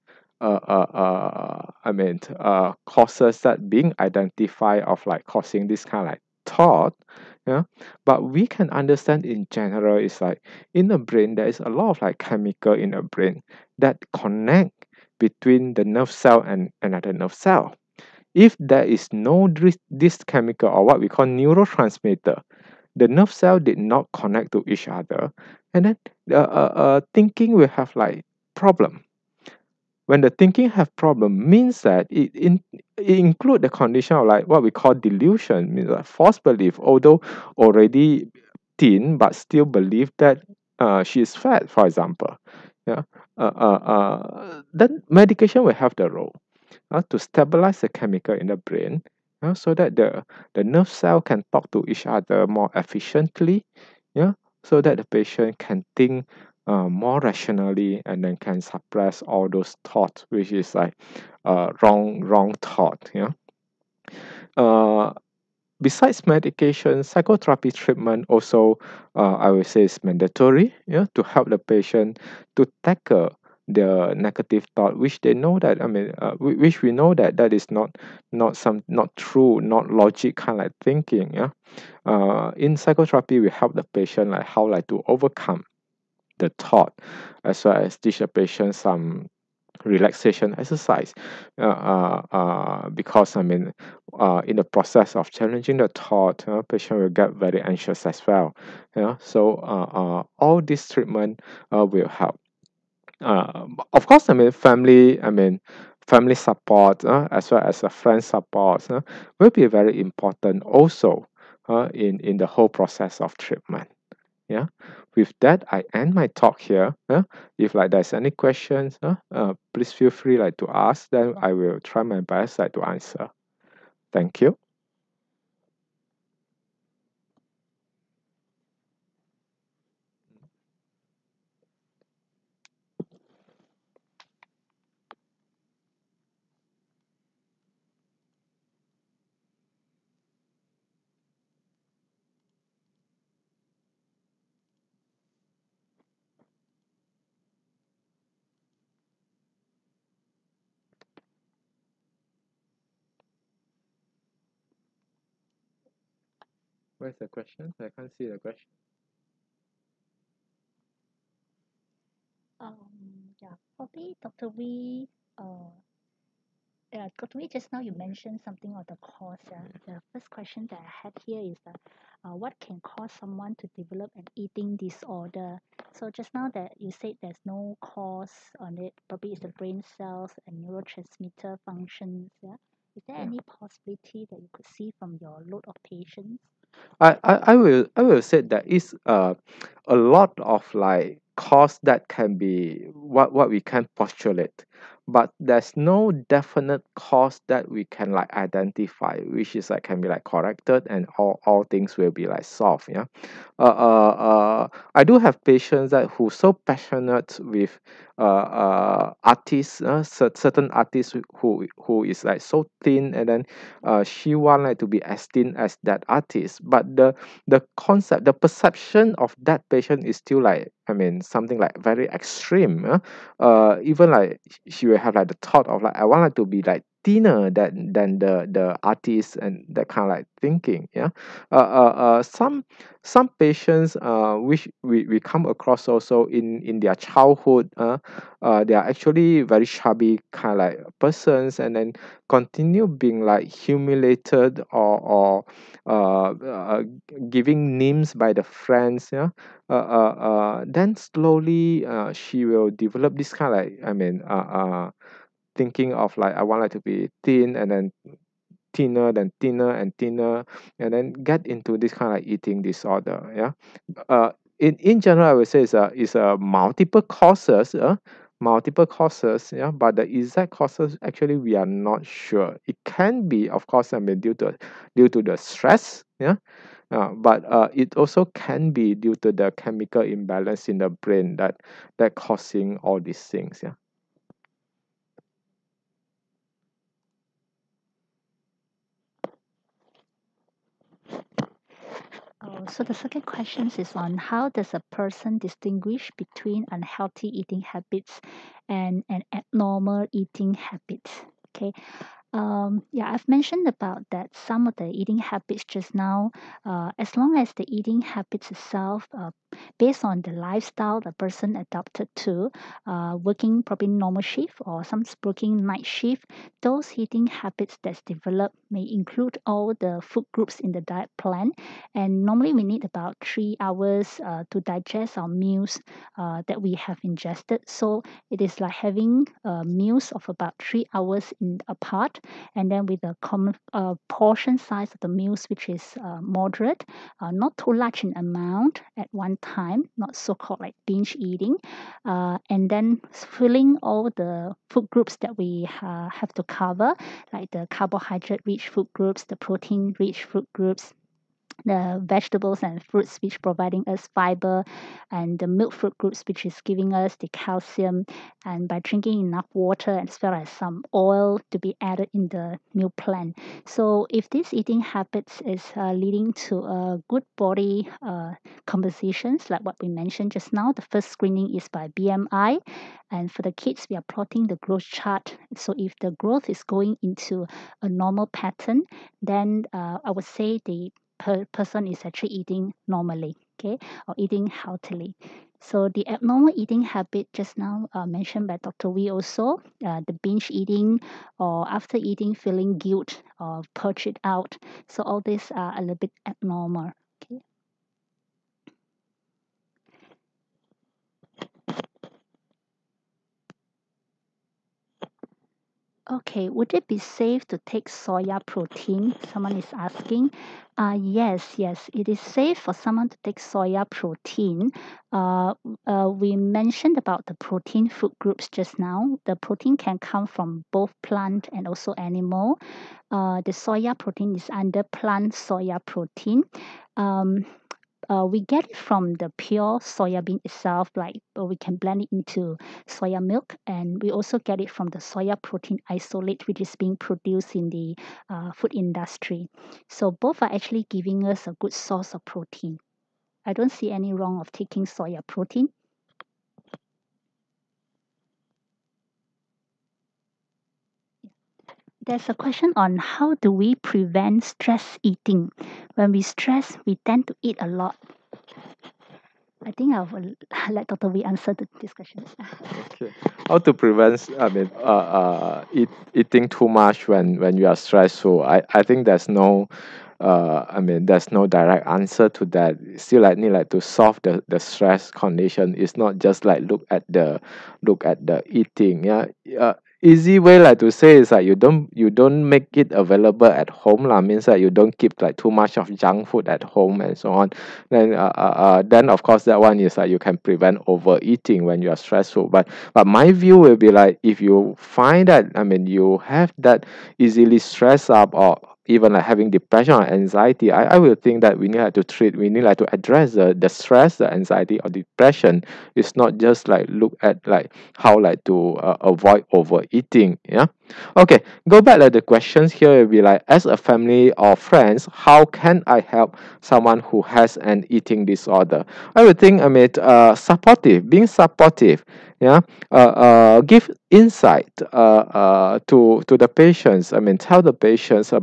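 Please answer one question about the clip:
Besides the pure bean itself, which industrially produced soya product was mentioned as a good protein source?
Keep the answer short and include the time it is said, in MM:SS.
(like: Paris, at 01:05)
soya protein isolate, at 07:14.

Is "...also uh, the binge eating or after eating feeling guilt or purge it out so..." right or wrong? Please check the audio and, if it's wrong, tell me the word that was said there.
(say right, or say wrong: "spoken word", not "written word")
right.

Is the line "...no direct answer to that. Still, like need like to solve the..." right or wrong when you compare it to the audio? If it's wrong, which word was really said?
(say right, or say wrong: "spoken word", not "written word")
right.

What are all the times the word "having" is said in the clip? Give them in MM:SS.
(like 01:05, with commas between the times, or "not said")
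05:28, 08:19.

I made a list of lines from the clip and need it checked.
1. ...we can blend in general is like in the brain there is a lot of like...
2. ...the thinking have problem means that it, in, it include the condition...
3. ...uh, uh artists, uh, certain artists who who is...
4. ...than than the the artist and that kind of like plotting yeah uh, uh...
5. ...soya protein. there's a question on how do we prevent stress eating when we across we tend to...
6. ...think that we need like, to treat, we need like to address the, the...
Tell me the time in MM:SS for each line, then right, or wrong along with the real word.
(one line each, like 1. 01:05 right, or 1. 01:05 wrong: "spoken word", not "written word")
1. 00:08 wrong: "understand", not "blend"
2. 00:30 right
3. 03:28 right
4. 03:47 wrong: "thinking", not "plotting"
5. 07:24 wrong: "stress", not "across"
6. 08:21 right.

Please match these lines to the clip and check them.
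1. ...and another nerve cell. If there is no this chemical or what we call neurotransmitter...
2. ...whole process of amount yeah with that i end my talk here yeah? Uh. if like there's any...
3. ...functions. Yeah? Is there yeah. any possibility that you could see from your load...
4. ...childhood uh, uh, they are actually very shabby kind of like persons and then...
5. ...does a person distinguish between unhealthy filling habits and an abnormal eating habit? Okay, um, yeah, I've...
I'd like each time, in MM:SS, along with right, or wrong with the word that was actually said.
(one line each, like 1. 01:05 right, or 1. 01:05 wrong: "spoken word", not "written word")
1. 00:16 right
2. 01:52 wrong: "treatment", not "amount"
3. 03:01 right
4. 03:56 right
5. 04:54 wrong: "eating", not "filling".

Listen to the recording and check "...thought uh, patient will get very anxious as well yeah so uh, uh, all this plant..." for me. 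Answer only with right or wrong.
wrong.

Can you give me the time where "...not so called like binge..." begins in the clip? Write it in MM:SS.
05:39.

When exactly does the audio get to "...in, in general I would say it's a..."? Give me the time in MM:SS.
04:24.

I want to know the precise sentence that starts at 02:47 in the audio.
Wee, just now you mentioned something on the cause.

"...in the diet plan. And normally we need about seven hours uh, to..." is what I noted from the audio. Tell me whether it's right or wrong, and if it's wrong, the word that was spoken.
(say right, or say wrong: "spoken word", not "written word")
wrong: "three", not "seven".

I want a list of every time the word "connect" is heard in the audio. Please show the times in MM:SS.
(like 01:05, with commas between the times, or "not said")
00:14, 00:24.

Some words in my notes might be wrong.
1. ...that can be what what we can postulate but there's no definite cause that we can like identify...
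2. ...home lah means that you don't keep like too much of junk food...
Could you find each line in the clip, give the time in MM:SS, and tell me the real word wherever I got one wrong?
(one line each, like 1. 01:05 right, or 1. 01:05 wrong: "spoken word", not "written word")
1. 03:11 right
2. 08:03 right.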